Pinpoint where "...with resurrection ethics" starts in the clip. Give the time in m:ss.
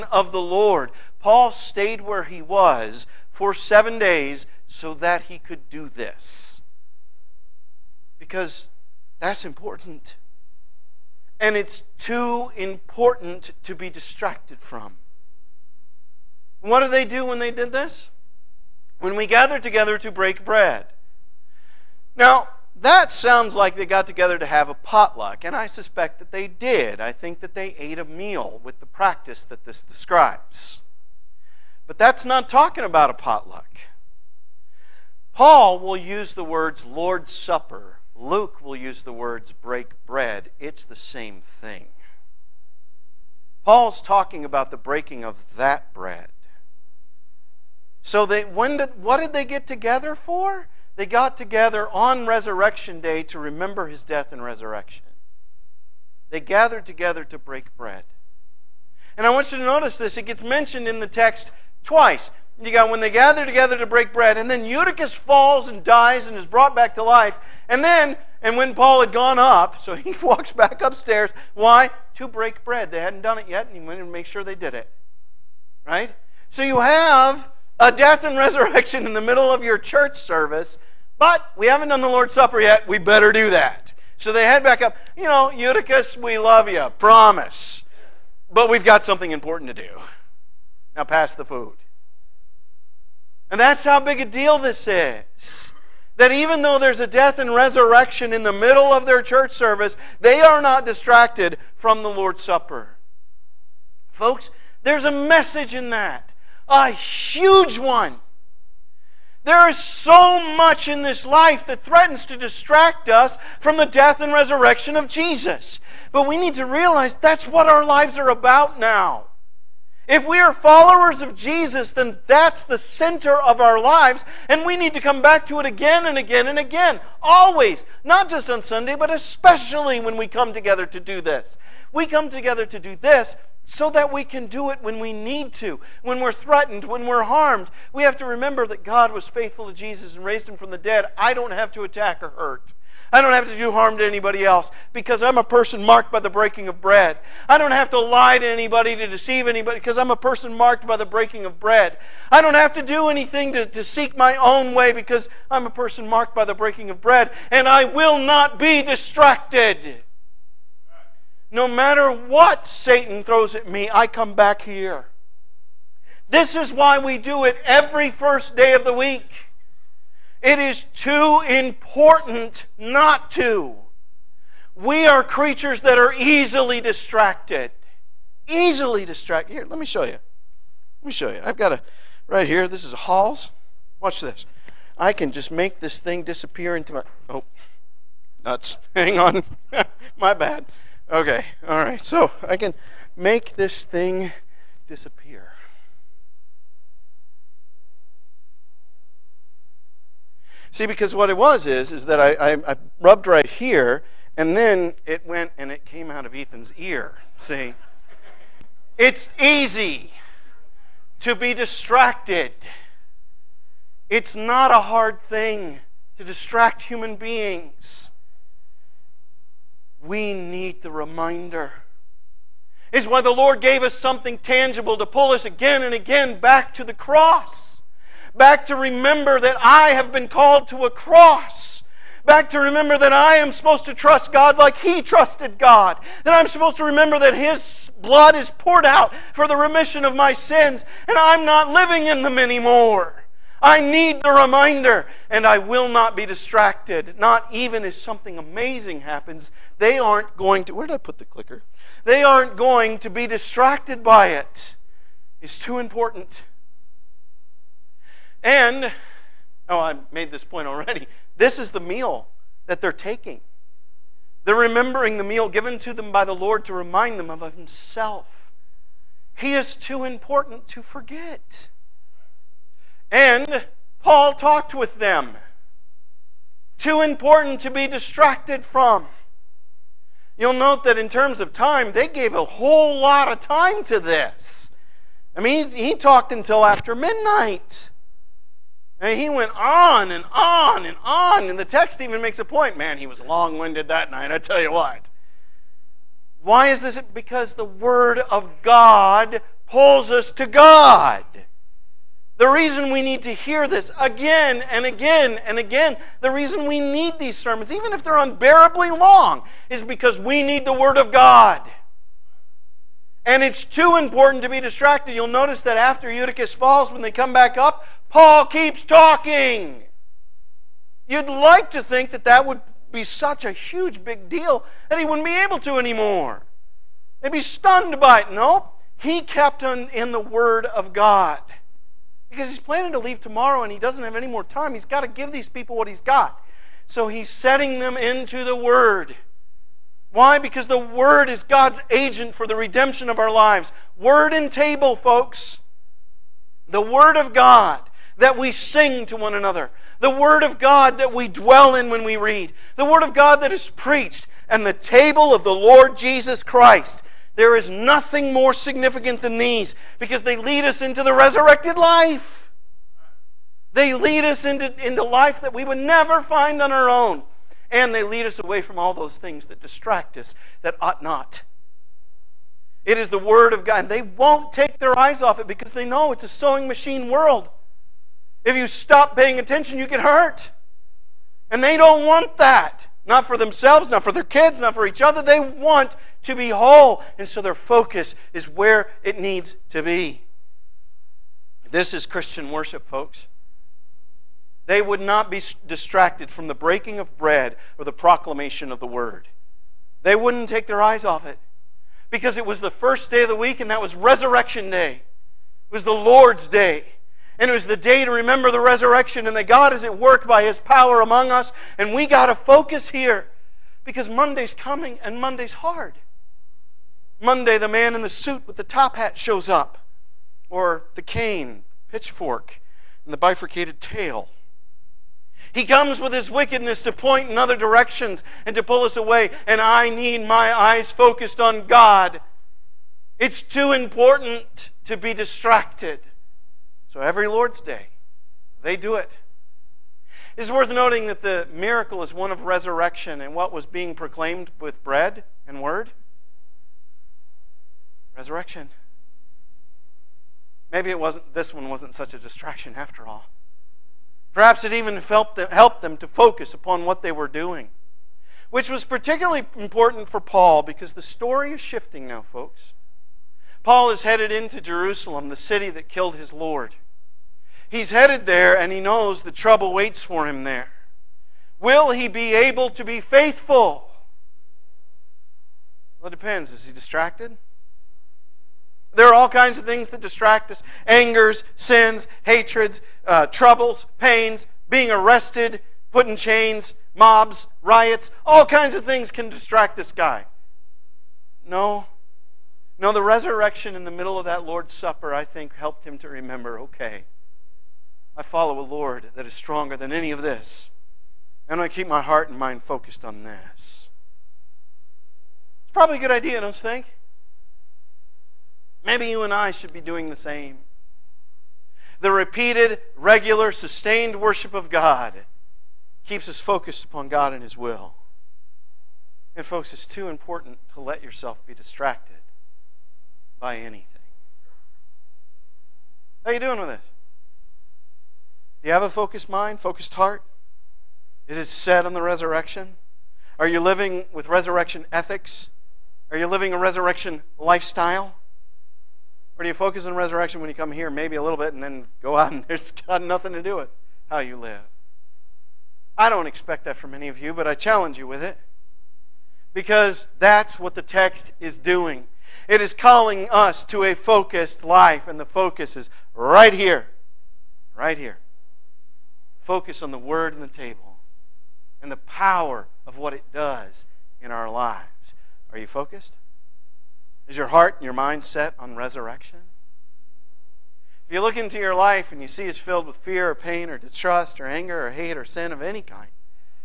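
8:54.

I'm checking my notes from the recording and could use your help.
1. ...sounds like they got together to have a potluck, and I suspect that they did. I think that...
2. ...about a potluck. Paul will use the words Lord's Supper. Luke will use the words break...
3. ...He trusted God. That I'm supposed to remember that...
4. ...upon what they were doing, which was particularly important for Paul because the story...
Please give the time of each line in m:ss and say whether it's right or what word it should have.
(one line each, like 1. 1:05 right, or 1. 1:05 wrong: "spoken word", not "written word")
1. 0:23 right
2. 0:32 right
3. 3:54 right
4. 7:36 right.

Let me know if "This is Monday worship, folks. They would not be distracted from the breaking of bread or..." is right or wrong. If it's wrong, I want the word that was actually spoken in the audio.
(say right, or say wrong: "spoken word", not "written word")
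wrong: "Christian", not "Monday".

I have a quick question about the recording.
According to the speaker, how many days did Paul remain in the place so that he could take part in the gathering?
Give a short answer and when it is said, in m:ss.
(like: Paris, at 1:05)
7, at 0:03.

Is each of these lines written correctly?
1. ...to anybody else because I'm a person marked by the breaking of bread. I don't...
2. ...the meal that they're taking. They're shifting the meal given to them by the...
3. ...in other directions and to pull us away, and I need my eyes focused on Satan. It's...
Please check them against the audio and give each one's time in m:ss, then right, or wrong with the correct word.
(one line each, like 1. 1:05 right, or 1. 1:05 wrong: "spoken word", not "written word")
1. 2:23 right
2. 4:21 wrong: "remembering", not "shifting"
3. 7:07 wrong: "God", not "Satan".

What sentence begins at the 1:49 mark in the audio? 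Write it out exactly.
There is so much in this life that threatens to distract us from the death and resurrection of Jesus.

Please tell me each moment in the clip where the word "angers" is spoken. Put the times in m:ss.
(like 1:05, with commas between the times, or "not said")
8:00, 9:34.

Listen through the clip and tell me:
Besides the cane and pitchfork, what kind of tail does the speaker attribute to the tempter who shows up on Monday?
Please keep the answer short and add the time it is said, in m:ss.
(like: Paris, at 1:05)
Bifurcated, at 7:03.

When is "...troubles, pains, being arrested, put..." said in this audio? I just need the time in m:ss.
8:03.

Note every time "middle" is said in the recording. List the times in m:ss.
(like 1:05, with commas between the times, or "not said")
1:19, 1:38, 8:13.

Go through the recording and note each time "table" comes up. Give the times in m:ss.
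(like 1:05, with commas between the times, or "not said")
5:44, 5:54, 9:20.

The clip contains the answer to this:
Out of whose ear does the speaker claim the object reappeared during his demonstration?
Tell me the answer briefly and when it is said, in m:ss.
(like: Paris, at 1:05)
Ethan, at 3:26.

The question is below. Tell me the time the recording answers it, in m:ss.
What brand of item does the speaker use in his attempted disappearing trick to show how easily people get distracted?
3:02.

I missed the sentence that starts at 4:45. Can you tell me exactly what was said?
I mean, he talked until after midnight.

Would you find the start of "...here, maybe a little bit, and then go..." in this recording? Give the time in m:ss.
9:00.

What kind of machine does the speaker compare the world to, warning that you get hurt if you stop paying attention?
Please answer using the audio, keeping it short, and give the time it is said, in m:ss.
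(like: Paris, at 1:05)
Sewing machine, at 6:16.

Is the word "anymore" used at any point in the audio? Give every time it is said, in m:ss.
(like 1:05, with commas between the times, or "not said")
4:02, 5:25.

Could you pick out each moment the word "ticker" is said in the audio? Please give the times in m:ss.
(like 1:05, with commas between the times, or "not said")
not said.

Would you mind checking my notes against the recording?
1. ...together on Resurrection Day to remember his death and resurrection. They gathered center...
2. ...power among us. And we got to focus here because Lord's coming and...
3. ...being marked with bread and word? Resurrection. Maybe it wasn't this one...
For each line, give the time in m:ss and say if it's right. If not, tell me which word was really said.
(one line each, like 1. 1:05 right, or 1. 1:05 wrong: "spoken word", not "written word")
1. 0:51 wrong: "together", not "center"
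2. 6:50 wrong: "Monday", not "Lord"
3. 7:23 wrong: "proclaimed", not "marked".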